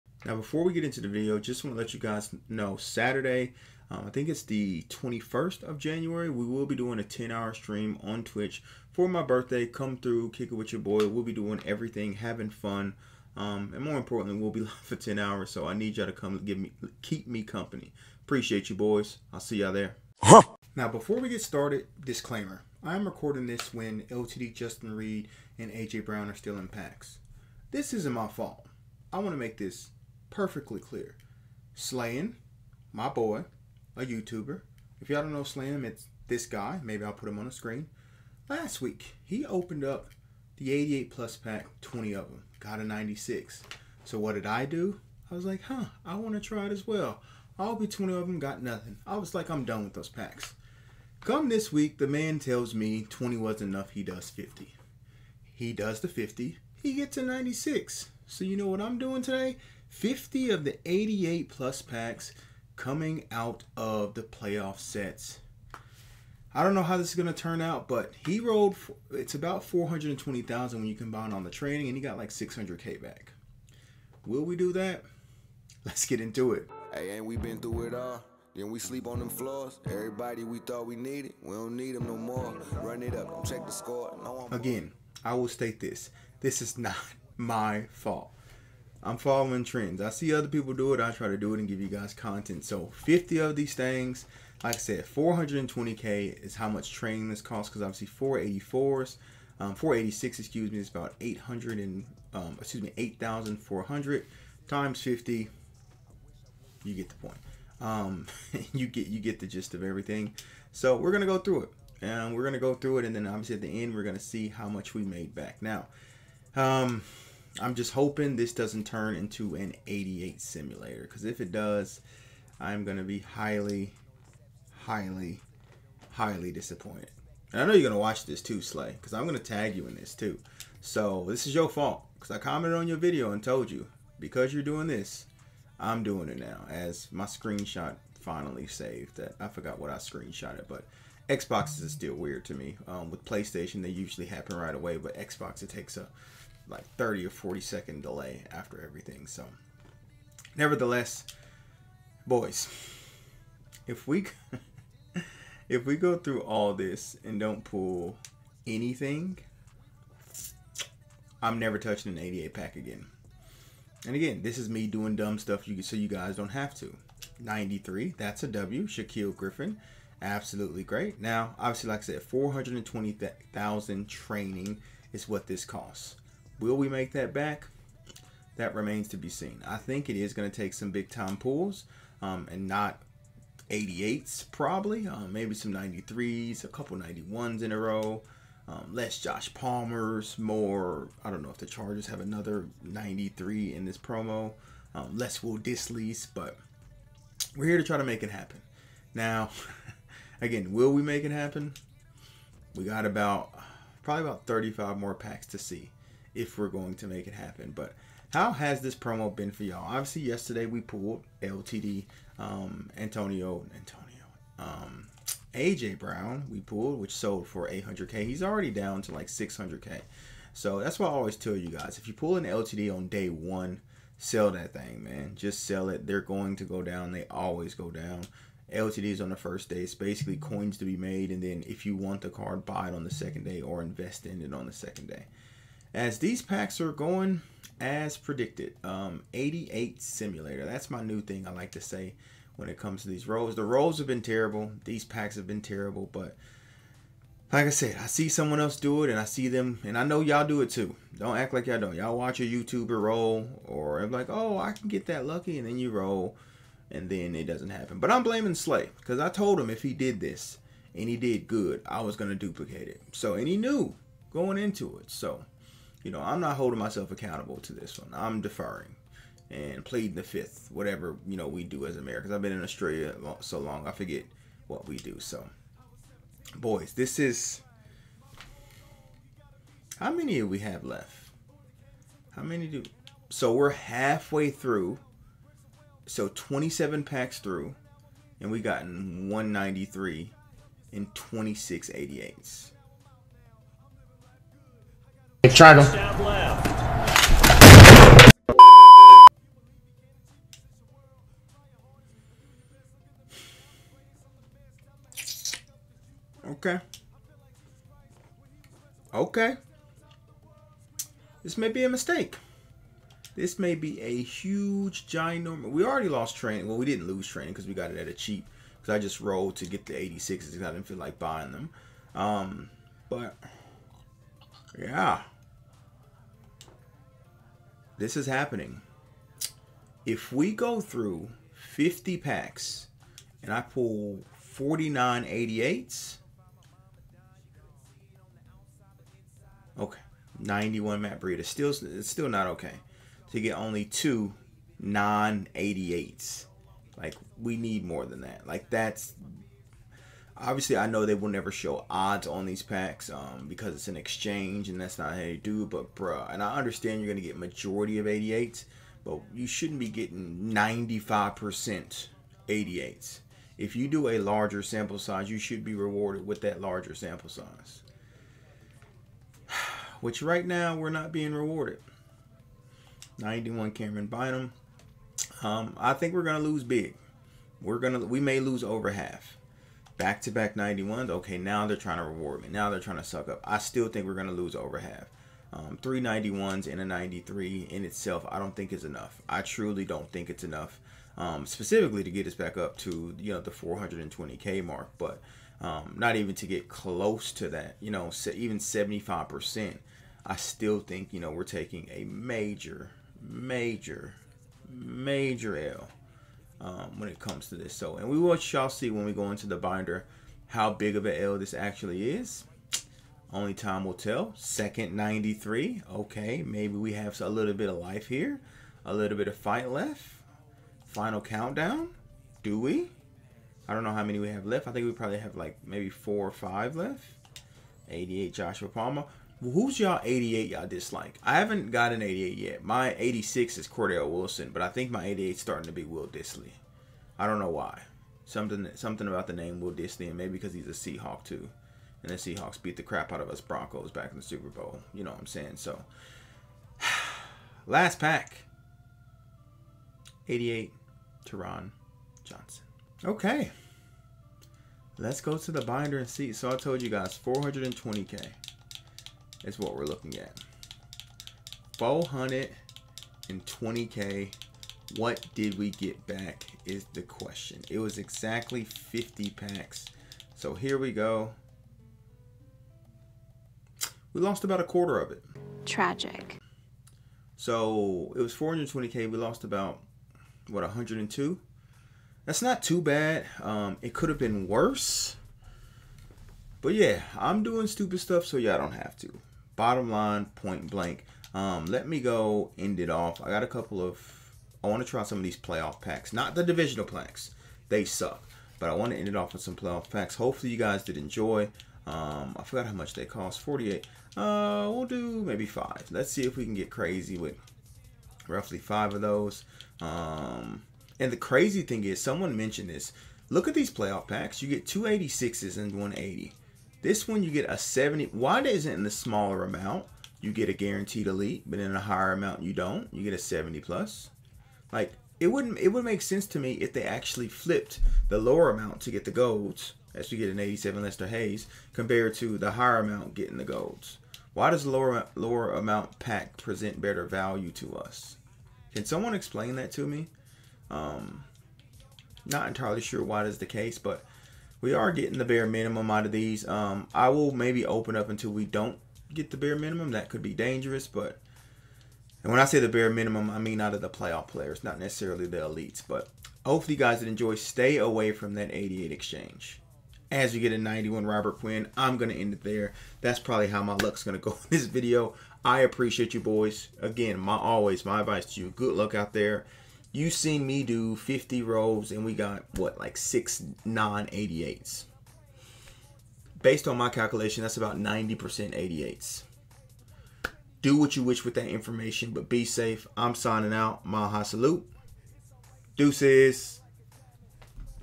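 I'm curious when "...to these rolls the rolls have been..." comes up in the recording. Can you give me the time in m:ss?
4:03.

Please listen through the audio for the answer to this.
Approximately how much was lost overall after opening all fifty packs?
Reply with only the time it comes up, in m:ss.
8:00.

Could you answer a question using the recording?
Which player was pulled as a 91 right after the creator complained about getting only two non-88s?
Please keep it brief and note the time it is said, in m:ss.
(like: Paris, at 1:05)
Matt Breida, at 5:41.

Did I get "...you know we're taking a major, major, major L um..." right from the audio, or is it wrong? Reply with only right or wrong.
right.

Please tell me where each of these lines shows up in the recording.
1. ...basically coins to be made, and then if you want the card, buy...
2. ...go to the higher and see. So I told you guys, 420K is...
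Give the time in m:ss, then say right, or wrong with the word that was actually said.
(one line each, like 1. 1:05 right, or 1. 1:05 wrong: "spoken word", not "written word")
1. 3:49 right
2. 7:35 wrong: "binder", not "higher".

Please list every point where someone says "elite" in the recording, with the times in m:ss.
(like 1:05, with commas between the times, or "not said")
8:41, 9:15.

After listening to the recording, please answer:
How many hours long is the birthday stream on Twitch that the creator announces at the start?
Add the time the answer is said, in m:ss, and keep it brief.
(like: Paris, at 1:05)
10, at 0:07.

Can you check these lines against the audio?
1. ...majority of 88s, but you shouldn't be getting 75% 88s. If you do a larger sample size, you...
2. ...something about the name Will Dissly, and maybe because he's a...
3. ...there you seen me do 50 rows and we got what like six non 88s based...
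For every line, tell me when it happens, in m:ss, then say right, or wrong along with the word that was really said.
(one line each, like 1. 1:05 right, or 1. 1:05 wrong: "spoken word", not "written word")
1. 5:57 wrong: "95", not "75"
2. 7:18 right
3. 9:29 right.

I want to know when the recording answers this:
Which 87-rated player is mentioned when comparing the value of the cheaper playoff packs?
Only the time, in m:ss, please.
8:50.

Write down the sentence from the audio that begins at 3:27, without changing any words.
But how has this promo been for y'all?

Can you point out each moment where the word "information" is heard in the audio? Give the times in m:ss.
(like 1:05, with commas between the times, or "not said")
9:41.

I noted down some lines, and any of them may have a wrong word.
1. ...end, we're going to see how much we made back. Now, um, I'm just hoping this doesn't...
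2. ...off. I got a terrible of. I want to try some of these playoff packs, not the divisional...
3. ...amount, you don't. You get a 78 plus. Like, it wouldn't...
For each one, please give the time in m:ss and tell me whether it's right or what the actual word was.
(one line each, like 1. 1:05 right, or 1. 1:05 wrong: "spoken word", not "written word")
1. 1:53 right
2. 8:12 wrong: "couple", not "terrible"
3. 8:42 wrong: "70", not "78".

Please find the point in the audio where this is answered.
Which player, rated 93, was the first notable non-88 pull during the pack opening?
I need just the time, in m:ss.
2:48.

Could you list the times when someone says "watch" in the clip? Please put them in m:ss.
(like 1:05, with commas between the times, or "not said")
2:07, 4:12.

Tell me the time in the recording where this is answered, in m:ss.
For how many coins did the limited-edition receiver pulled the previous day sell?
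3:37.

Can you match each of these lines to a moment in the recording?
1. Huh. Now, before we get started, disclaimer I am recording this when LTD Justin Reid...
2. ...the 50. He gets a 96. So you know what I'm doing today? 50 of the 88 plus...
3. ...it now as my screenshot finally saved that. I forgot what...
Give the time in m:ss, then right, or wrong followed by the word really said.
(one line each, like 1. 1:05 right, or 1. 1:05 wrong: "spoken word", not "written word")
1. 0:20 right
2. 0:55 right
3. 2:16 right.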